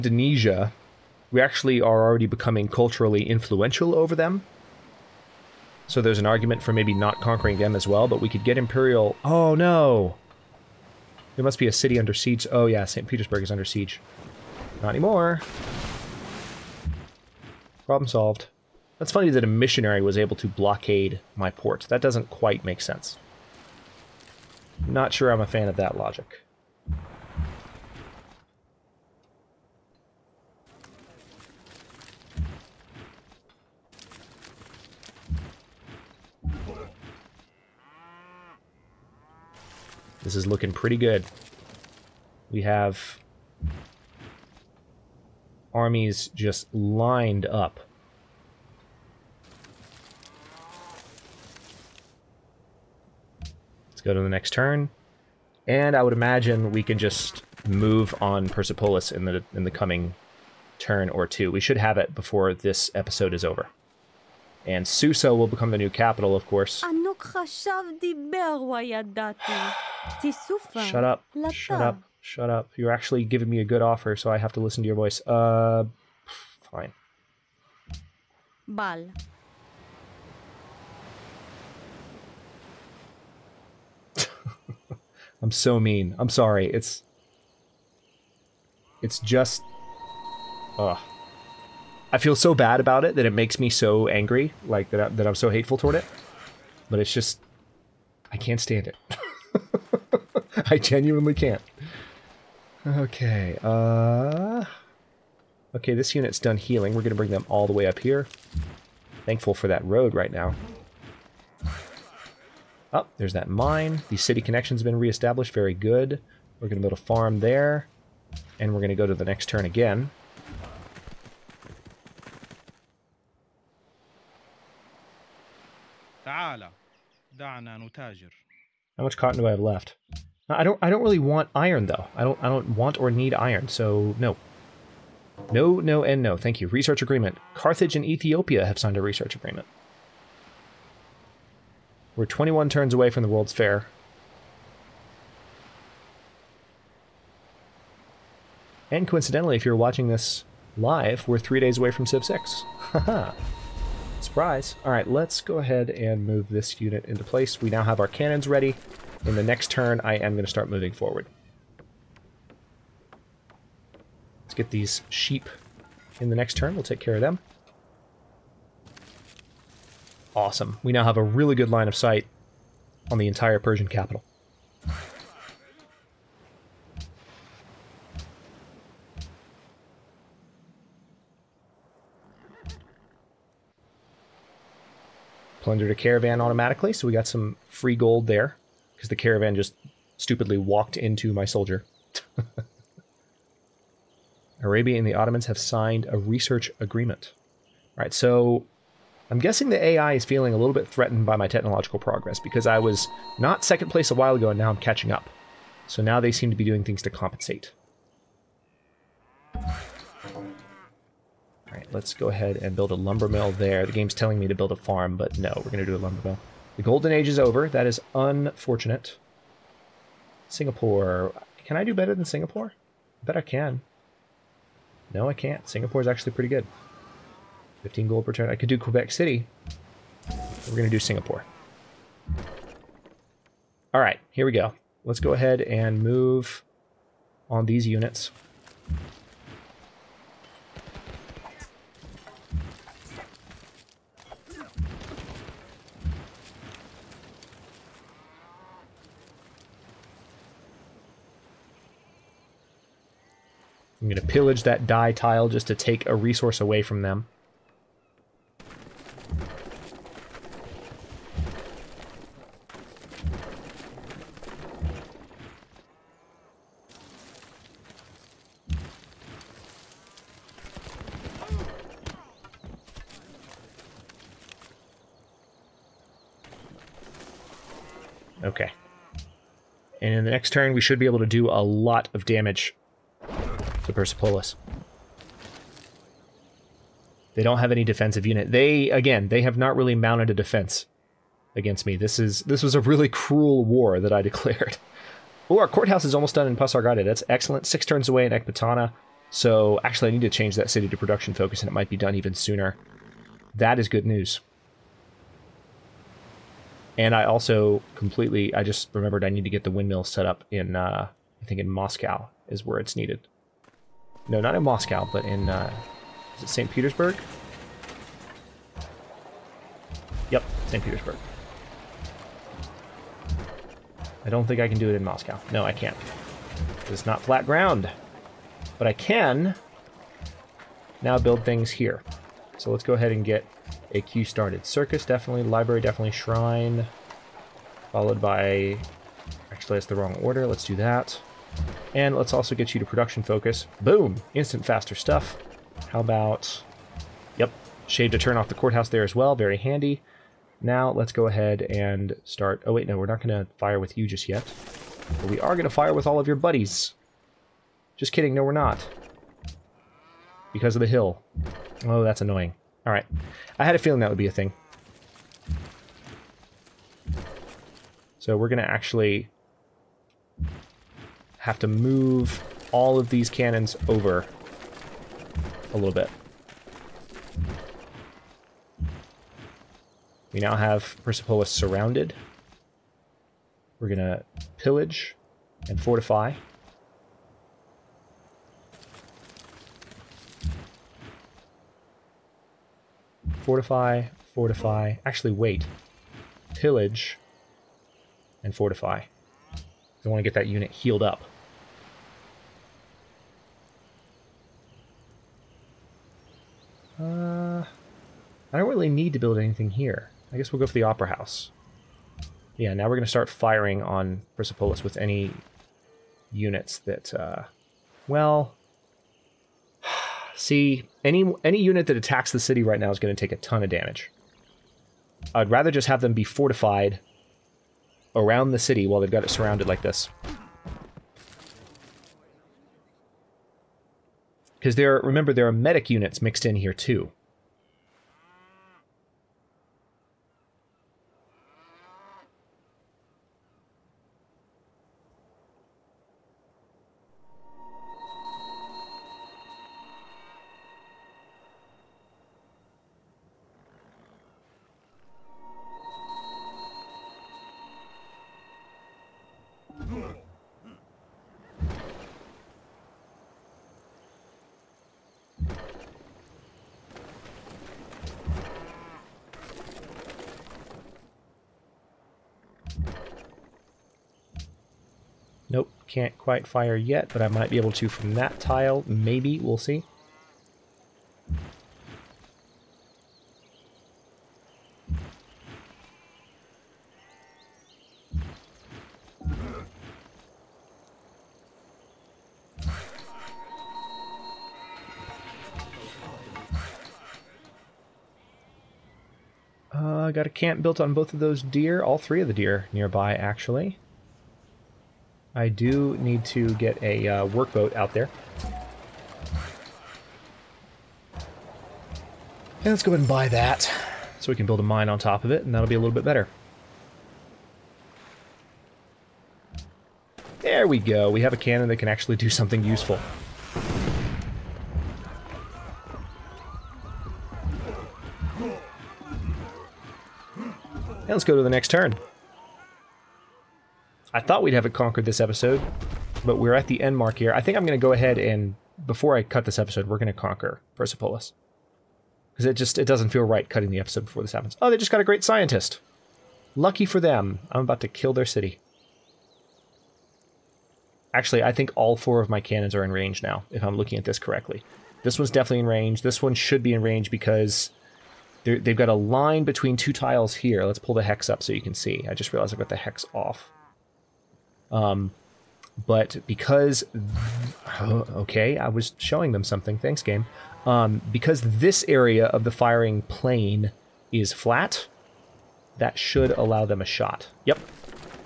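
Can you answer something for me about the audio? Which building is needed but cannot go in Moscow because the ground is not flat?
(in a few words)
windmill.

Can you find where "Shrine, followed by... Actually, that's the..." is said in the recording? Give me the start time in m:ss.
5:36.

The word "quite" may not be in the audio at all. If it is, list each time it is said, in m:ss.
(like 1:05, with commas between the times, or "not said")
0:22, 7:56.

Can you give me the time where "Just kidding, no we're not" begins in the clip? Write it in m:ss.
5:57.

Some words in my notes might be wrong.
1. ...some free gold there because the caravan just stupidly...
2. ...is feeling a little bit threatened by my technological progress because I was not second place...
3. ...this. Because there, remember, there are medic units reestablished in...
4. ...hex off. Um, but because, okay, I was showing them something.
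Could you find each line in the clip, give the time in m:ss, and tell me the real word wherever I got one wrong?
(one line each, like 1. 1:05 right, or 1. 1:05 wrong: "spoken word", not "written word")
1. 3:07 right
2. 3:20 right
3. 7:09 wrong: "mixed", not "reestablished"
4. 9:22 right.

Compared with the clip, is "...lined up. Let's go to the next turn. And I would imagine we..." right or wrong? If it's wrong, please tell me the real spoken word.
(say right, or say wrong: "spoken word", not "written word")
right.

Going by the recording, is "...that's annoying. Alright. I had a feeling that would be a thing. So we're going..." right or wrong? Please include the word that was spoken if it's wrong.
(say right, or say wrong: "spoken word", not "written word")
right.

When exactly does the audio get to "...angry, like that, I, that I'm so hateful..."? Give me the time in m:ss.
1:34.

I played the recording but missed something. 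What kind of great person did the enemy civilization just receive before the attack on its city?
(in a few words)
great scientist.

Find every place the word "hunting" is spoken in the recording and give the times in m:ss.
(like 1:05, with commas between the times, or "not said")
not said.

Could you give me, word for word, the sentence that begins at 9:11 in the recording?
Actually, I think all four of my cannons are in range now, if I'm looking at this correctly.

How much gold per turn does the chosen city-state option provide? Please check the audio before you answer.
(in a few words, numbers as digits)
15.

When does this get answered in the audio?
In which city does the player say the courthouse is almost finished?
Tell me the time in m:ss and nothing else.
4:56.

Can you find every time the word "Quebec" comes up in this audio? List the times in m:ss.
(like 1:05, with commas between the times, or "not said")
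3:48.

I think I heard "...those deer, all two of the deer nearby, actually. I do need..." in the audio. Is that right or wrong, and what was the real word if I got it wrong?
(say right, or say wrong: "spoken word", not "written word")
wrong: "three", not "two".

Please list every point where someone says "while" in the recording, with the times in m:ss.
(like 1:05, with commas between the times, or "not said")
3:24, 7:08.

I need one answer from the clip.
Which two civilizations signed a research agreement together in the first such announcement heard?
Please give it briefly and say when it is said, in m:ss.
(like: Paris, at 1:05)
Carthage and Ethiopia, at 2:17.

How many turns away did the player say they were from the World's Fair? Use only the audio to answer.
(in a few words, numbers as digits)
21.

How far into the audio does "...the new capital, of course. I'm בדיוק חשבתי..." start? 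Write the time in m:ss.
1:05.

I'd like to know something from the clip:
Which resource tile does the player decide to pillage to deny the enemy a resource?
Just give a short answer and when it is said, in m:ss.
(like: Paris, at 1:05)
dye, at 4:14.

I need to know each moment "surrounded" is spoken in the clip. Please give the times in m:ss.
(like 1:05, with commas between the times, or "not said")
6:21, 7:09.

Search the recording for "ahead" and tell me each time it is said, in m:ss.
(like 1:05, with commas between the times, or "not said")
2:35, 3:32, 3:55, 5:32, 5:51, 8:32, 8:57.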